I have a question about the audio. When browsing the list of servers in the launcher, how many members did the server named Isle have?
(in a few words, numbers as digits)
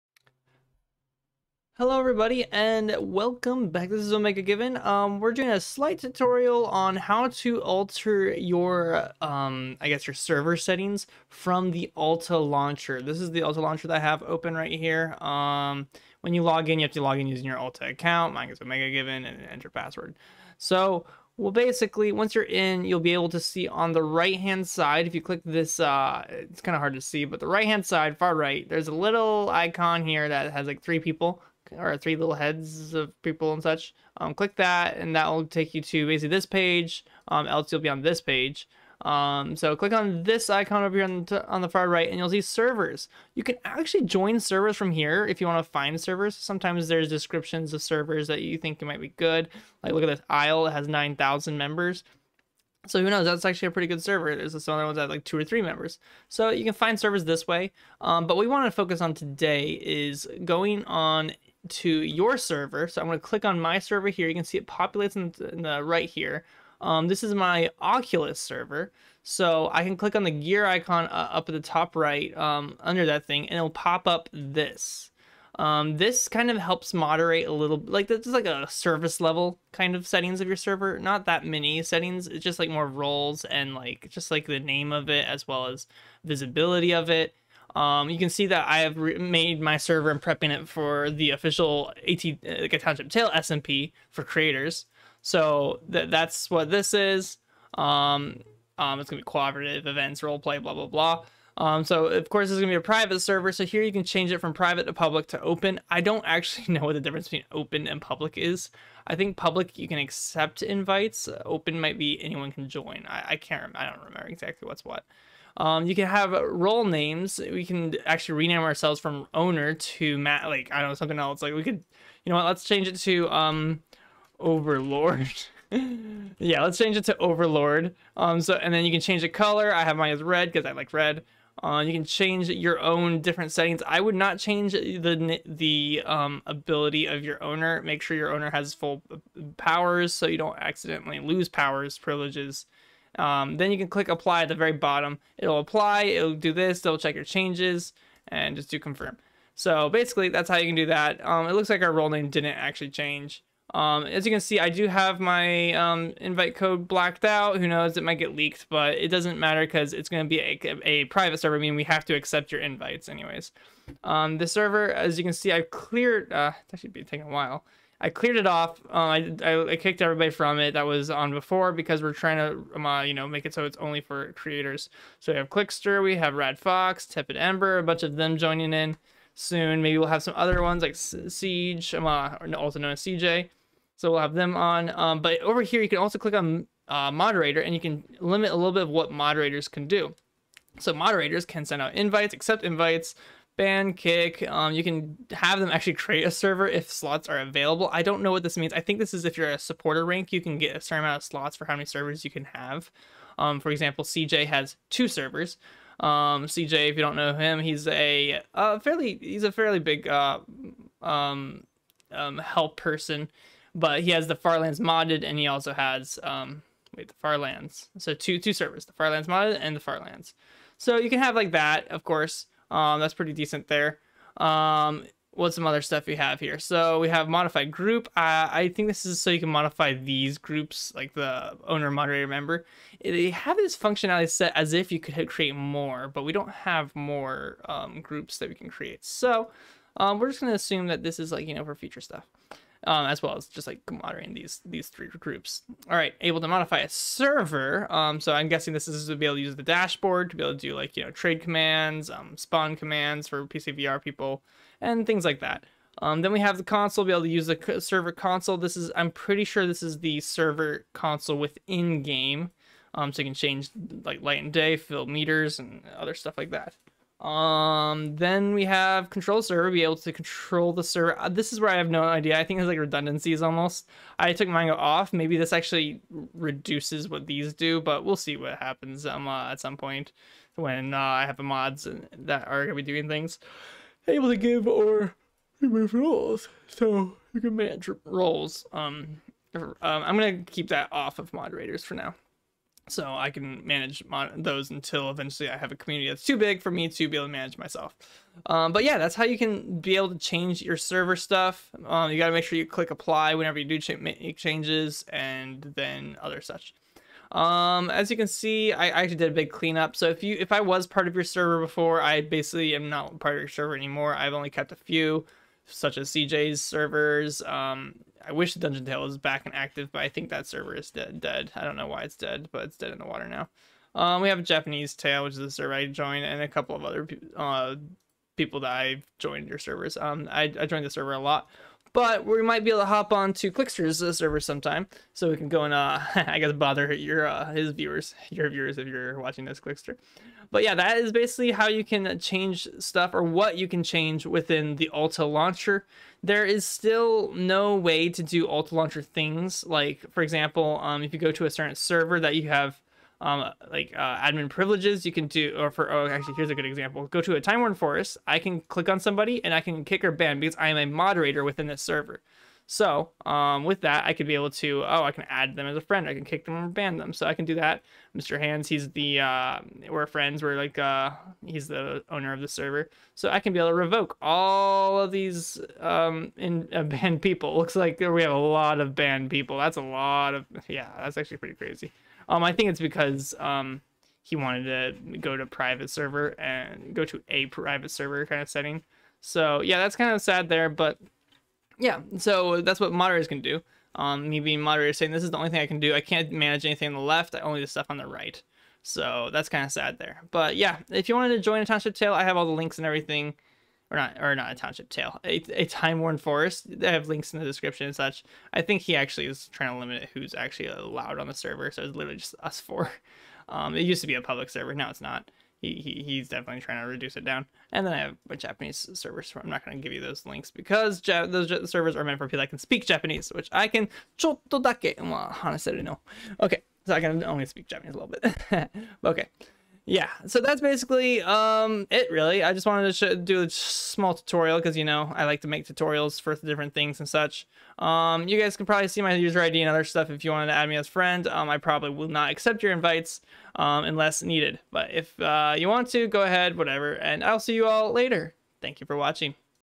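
9,000.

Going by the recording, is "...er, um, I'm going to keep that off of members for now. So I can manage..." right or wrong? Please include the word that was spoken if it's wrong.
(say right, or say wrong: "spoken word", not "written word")
wrong: "moderators", not "members".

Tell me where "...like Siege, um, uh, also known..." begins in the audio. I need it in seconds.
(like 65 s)
180 s.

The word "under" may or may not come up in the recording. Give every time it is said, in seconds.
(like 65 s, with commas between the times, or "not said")
72 s.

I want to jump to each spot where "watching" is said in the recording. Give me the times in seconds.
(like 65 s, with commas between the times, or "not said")
339 s, 448 s.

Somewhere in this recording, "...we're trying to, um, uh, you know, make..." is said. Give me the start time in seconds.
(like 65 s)
172 s.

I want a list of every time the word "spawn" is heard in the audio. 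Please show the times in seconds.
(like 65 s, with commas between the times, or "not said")
252 s.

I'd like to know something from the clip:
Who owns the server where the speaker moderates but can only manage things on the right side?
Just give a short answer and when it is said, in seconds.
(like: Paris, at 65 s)
Mr. Hands, at 368 s.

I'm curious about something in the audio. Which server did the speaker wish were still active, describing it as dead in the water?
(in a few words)
Dungeon Tale.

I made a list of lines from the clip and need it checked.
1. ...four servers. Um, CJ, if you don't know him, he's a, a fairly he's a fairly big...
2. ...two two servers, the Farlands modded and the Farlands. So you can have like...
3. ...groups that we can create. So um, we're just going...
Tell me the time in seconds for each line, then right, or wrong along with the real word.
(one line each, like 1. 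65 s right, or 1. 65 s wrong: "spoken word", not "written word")
1. 204 s wrong: "two", not "four"
2. 218 s right
3. 238 s right.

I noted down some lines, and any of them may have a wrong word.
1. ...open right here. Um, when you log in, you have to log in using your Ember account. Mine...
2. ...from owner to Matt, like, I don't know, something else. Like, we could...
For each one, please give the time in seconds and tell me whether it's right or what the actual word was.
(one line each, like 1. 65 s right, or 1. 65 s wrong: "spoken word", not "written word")
1. 14 s wrong: "Alta", not "Ember"
2. 118 s right.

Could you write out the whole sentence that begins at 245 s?
All right, able to modify a server.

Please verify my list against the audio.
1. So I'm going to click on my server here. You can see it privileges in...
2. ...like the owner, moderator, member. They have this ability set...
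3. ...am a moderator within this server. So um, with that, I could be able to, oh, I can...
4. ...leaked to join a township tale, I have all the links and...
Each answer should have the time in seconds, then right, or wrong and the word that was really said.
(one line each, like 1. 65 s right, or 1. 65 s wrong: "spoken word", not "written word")
1. 62 s wrong: "populates", not "privileges"
2. 230 s wrong: "functionality", not "ability"
3. 360 s right
4. 401 s wrong: "wanted", not "leaked".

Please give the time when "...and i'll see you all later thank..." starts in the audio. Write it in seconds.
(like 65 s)
446 s.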